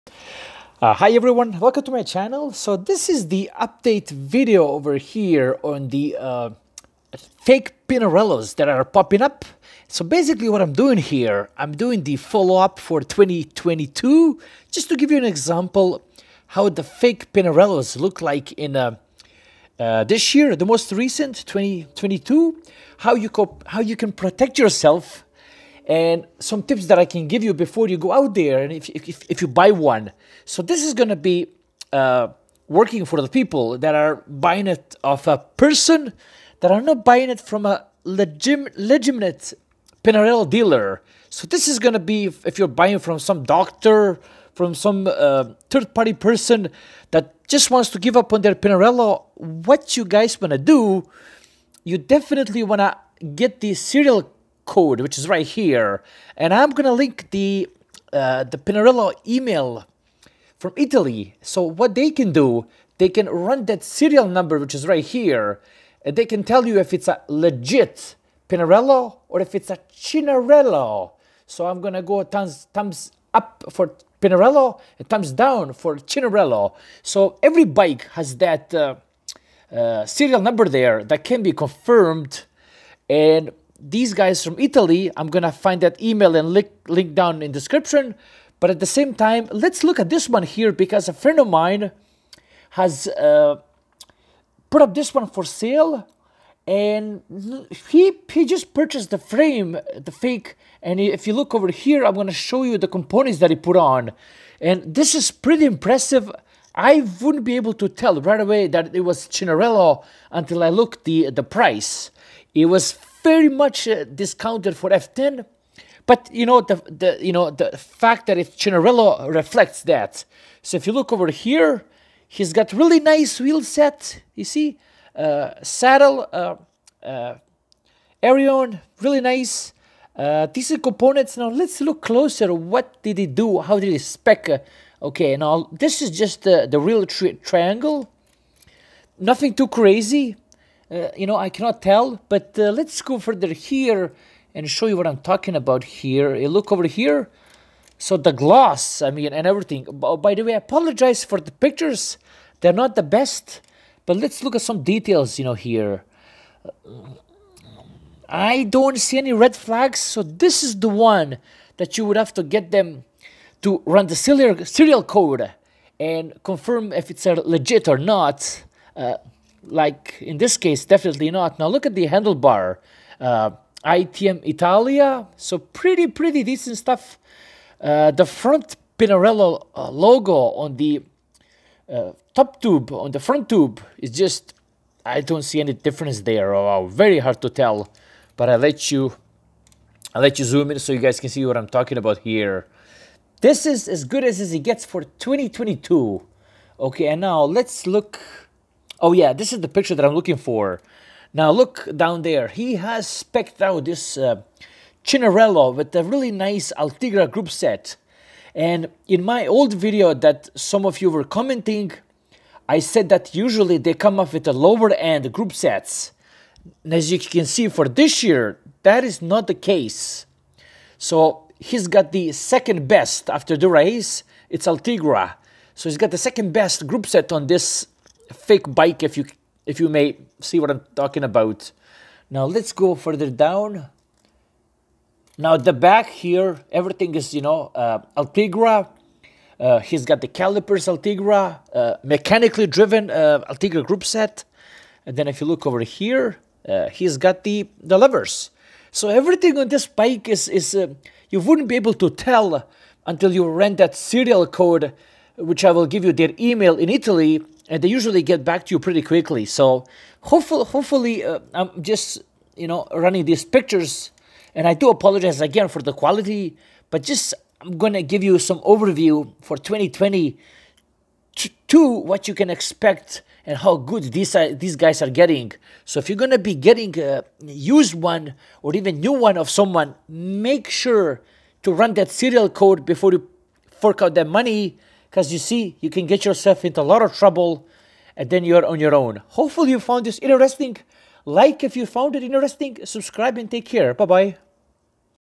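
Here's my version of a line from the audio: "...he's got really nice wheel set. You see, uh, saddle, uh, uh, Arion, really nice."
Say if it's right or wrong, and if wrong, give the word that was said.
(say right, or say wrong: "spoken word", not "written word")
right.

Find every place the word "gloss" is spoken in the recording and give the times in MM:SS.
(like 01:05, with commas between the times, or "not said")
02:28.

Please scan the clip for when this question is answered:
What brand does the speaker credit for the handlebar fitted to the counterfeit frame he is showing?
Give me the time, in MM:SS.
02:53.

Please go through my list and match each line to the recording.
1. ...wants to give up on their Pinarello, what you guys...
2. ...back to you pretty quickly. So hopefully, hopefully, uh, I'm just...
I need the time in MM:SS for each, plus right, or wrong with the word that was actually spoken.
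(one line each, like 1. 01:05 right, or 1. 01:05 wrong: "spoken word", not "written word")
1. 00:47 right
2. 04:18 right.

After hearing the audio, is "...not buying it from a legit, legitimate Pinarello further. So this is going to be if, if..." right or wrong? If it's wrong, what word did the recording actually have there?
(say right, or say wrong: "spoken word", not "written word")
wrong: "dealer", not "further".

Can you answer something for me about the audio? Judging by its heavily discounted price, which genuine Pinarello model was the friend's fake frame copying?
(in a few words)
F10.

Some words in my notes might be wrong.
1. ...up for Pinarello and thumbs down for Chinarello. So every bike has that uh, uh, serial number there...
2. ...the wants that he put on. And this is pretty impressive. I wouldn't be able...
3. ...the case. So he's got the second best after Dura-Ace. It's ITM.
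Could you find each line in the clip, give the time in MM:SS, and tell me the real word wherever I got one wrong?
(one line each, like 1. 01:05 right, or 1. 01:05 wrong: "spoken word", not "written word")
1. 01:13 right
2. 01:42 wrong: "components", not "wants"
3. 03:39 wrong: "Ultegra", not "ITM".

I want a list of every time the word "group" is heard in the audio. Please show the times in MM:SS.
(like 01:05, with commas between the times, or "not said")
03:27, 03:35, 03:46, 04:03.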